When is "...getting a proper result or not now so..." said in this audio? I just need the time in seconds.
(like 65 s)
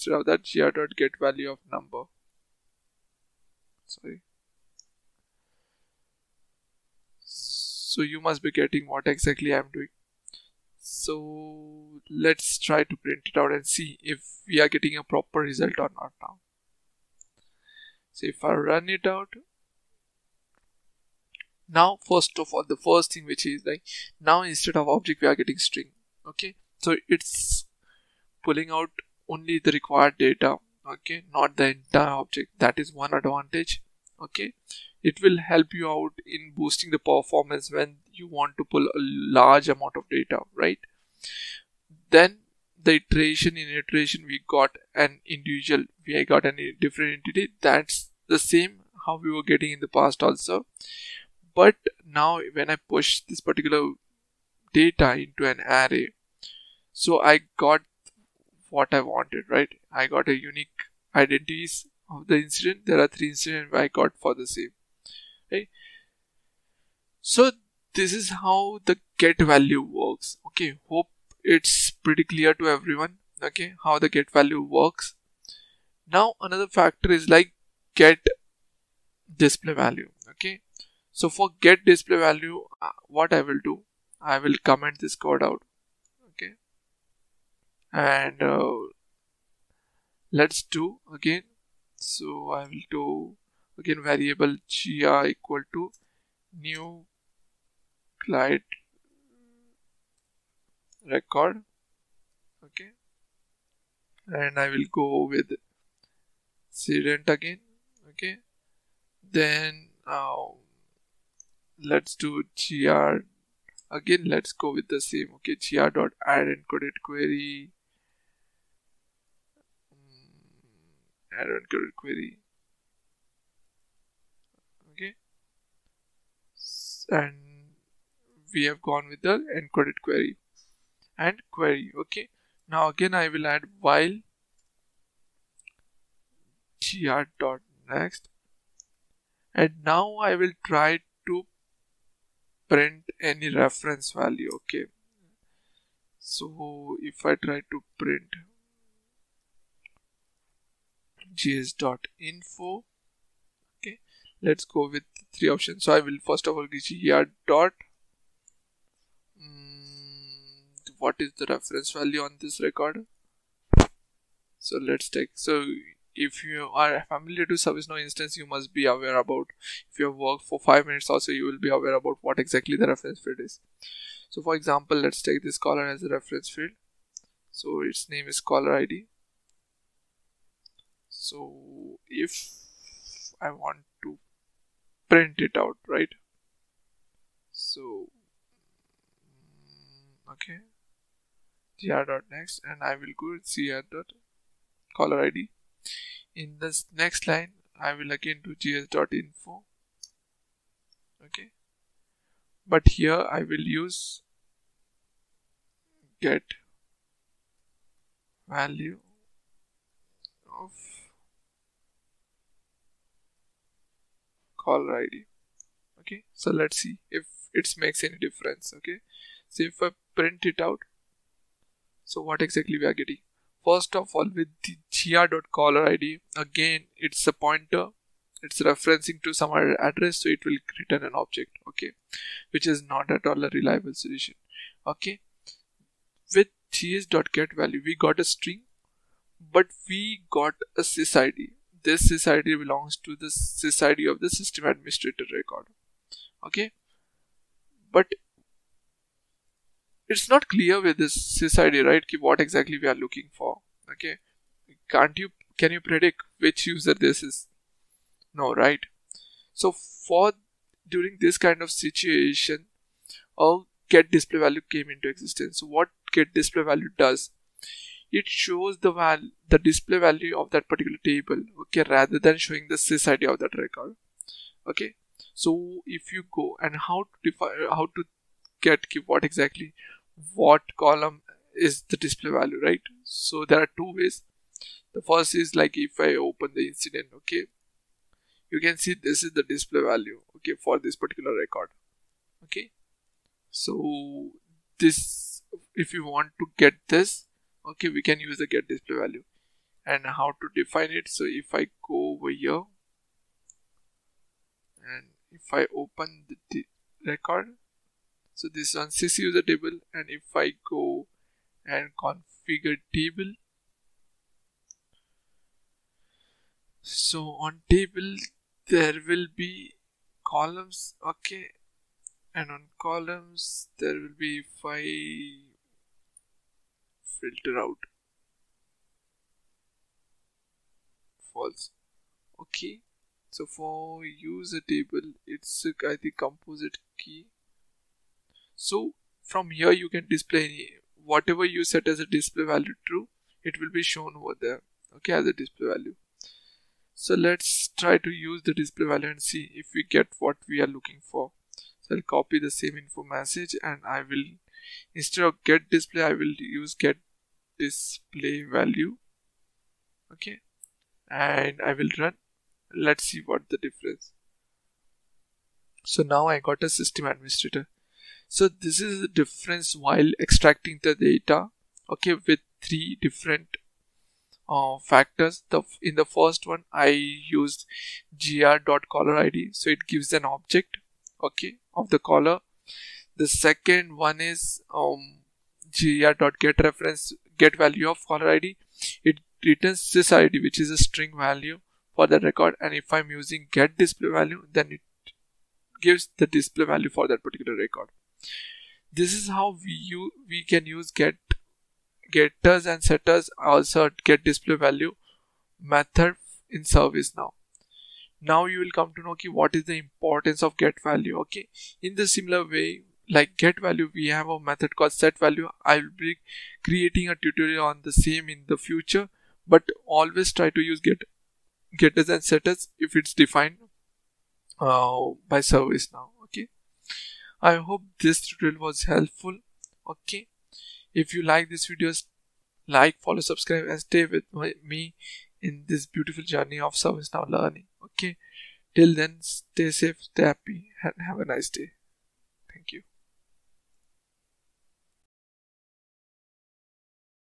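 14 s.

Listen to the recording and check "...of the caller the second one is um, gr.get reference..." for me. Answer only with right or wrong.
right.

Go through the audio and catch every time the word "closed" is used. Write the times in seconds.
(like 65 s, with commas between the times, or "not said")
not said.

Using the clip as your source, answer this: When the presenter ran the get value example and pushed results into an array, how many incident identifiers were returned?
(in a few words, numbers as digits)
3.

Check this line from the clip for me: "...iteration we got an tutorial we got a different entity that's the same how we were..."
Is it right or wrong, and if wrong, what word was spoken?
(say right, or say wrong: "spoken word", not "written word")
wrong: "individual", not "tutorial".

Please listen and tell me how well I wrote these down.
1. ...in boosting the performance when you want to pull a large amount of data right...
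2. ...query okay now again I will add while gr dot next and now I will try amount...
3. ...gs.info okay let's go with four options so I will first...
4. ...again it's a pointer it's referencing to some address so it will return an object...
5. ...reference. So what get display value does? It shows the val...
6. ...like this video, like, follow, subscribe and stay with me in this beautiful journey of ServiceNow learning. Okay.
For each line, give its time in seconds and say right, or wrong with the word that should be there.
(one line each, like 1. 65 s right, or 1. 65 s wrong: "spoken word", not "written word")
1. 36 s right
2. 131 s wrong: "print", not "amount"
3. 151 s wrong: "three", not "four"
4. 226 s right
5. 265 s wrong: "existence", not "reference"
6. 431 s right.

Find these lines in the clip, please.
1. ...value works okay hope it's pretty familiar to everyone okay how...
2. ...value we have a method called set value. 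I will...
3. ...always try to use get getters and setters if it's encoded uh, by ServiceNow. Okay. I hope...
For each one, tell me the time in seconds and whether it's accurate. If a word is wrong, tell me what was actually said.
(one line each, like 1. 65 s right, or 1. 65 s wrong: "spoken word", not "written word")
1. 69 s wrong: "clear", not "familiar"
2. 413 s right
3. 419 s wrong: "defined", not "encoded".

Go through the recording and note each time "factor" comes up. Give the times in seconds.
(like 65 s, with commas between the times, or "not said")
76 s, 374 s.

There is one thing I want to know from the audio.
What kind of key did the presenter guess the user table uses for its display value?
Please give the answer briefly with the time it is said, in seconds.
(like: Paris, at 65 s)
composite key, at 336 s.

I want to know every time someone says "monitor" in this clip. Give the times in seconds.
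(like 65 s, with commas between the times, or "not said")
not said.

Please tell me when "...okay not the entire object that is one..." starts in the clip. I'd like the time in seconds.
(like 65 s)
30 s.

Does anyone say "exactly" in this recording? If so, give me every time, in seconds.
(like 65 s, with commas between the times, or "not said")
9 s, 172 s, 222 s, 252 s, 279 s.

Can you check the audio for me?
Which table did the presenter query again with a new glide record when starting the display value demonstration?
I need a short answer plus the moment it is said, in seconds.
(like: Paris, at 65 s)
student, at 106 s.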